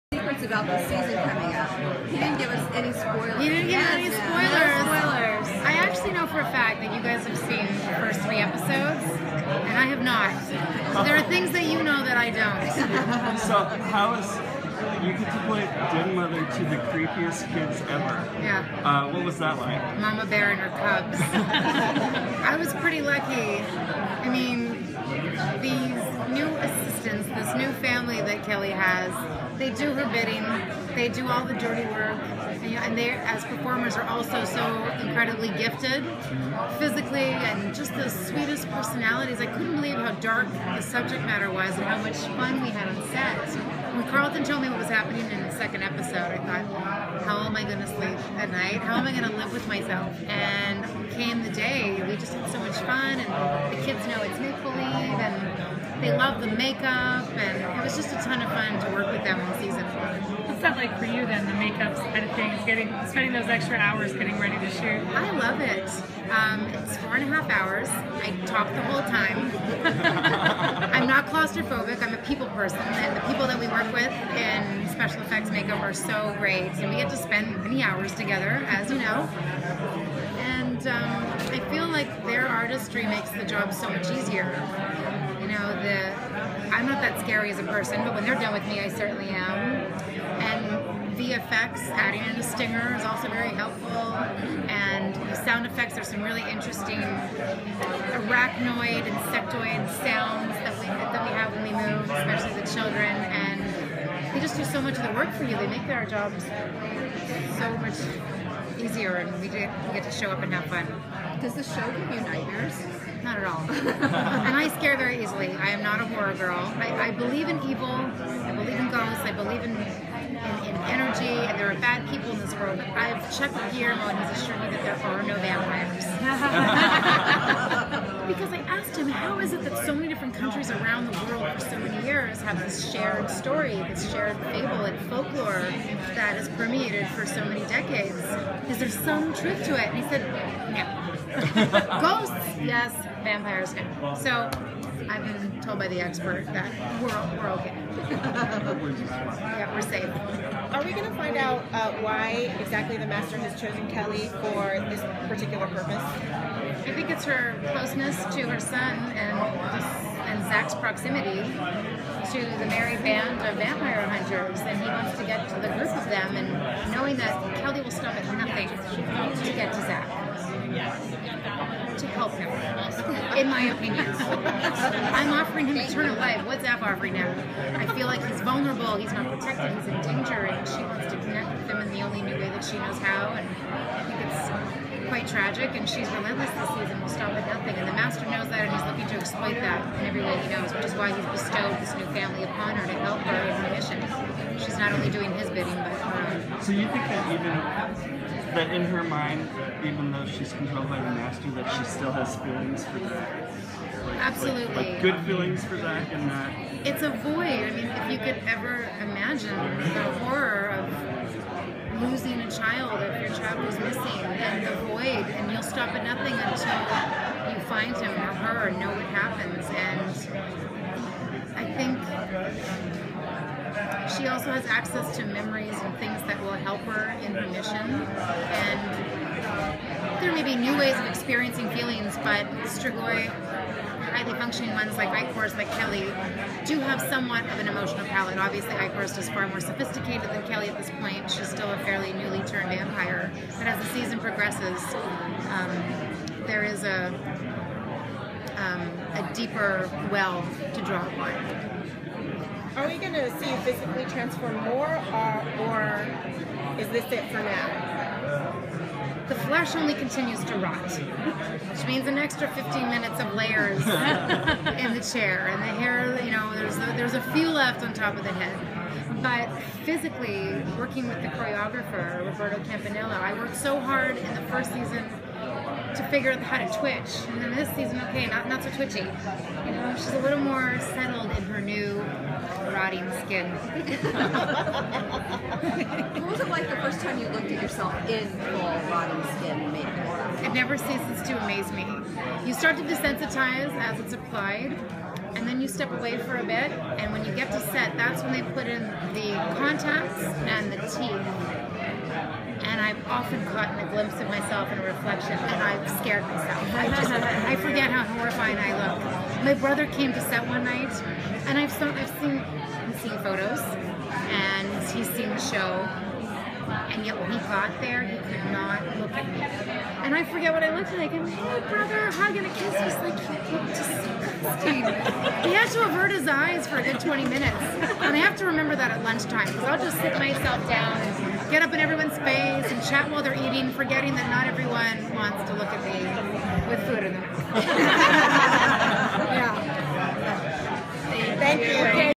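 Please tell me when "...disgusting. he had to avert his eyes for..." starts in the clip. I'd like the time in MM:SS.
05:23.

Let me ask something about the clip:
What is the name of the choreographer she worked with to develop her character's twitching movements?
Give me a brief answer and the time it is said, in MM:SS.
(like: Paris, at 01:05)
Roberto Campanella, at 04:32.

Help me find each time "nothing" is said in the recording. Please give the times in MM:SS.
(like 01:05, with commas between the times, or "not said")
02:48, 03:07, 03:36.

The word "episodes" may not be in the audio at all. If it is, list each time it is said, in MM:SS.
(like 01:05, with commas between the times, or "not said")
00:08, 00:45.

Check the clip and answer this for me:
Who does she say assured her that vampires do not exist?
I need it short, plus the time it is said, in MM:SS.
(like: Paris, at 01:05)
Guillermo, at 02:03.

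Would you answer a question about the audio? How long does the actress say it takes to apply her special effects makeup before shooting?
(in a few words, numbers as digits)
4.5 hours.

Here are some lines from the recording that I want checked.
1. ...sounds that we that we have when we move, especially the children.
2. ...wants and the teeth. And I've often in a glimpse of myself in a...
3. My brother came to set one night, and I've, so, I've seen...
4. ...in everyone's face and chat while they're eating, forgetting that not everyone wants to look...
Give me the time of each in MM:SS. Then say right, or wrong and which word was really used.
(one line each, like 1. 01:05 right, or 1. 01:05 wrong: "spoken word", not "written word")
1. 01:40 right
2. 04:59 wrong: "contacts", not "wants"
3. 05:09 right
4. 05:31 right.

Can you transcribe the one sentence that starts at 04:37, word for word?
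And then this season, okay, not not so twitchy.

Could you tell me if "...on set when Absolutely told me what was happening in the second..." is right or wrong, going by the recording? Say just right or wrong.
wrong.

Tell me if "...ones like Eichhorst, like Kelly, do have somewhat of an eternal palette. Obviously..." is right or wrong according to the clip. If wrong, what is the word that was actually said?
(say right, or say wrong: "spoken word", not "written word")
wrong: "emotional", not "eternal".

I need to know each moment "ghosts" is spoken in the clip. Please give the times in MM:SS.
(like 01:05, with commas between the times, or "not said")
01:58, 02:22.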